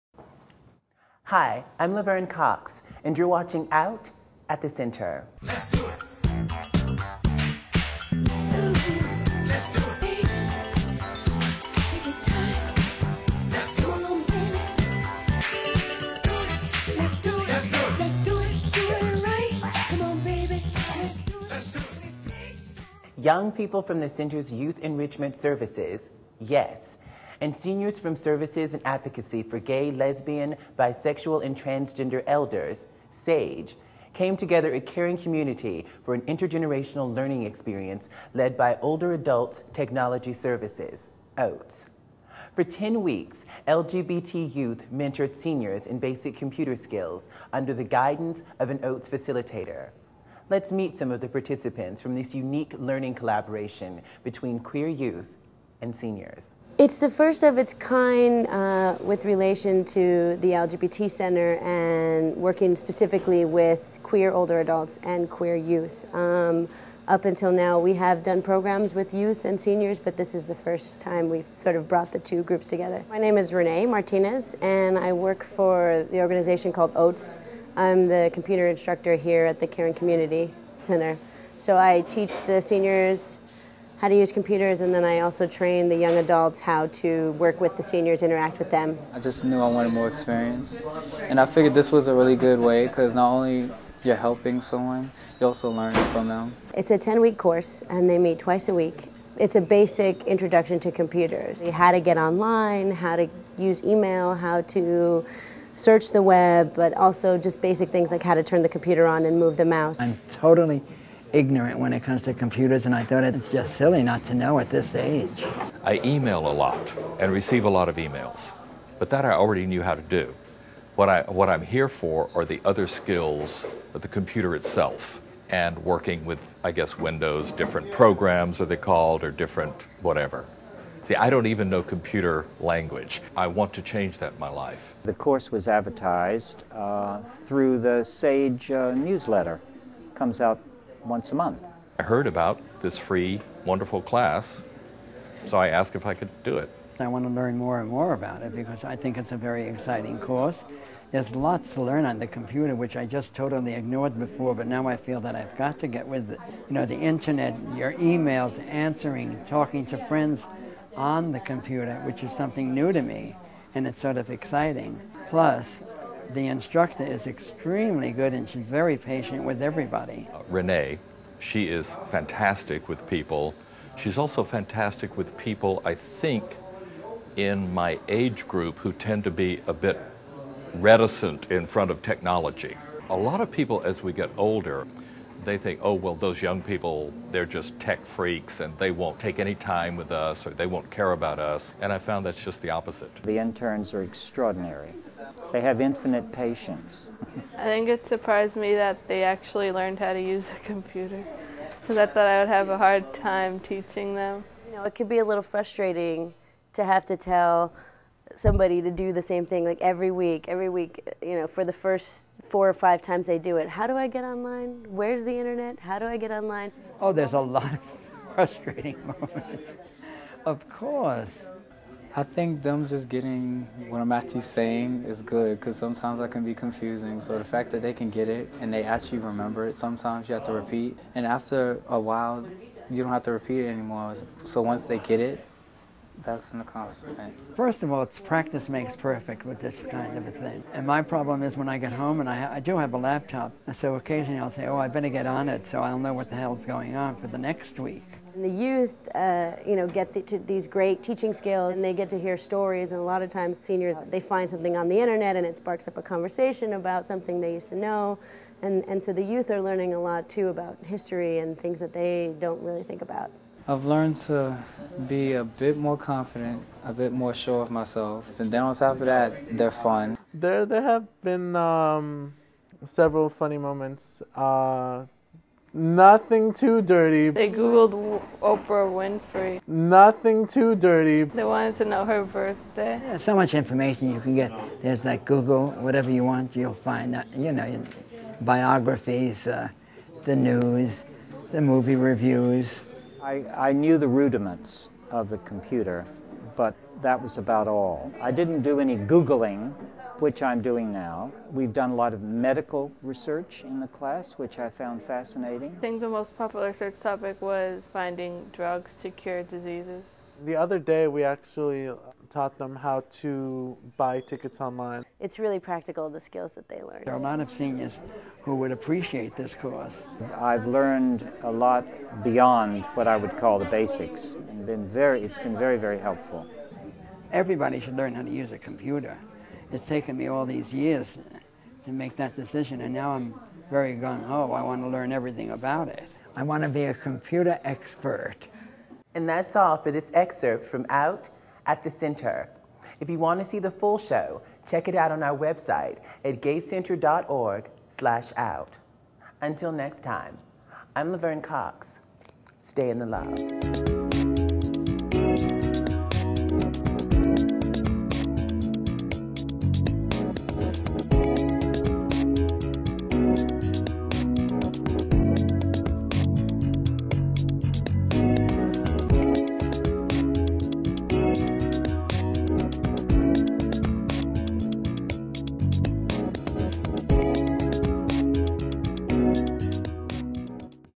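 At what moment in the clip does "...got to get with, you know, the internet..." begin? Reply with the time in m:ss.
2:35.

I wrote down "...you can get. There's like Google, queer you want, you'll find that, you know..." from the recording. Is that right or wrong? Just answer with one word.
wrong.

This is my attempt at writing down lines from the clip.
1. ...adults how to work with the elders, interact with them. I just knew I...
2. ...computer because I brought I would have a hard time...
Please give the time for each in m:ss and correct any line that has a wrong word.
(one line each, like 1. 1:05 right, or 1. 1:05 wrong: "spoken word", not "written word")
1. 1:26 wrong: "seniors", not "elders"
2. 3:20 wrong: "thought", not "brought".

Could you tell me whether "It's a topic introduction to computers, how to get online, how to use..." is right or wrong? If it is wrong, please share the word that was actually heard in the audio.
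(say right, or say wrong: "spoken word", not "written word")
wrong: "basic", not "topic".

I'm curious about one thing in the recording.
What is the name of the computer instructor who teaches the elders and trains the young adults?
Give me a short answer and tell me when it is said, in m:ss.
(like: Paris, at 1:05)
Renee Martinez, at 1:13.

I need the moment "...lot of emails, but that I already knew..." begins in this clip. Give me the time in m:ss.
1:57.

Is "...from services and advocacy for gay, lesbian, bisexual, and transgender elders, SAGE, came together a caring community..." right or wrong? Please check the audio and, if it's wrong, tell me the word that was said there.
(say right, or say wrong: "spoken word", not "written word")
right.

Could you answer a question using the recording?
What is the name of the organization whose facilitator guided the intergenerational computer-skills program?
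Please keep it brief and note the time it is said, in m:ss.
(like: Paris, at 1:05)
Older Adults Technology Services (OATS), at 0:38.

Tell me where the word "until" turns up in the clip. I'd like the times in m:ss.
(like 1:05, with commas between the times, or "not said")
1:07, 5:49.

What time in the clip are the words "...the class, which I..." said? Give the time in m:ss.
5:03.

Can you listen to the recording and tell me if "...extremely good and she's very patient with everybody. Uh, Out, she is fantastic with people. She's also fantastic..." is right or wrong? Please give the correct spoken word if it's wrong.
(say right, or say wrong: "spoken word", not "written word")
wrong: "Renee", not "Out".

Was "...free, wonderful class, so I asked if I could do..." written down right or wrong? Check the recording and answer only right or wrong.
right.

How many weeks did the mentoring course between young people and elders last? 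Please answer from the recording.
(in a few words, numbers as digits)
10.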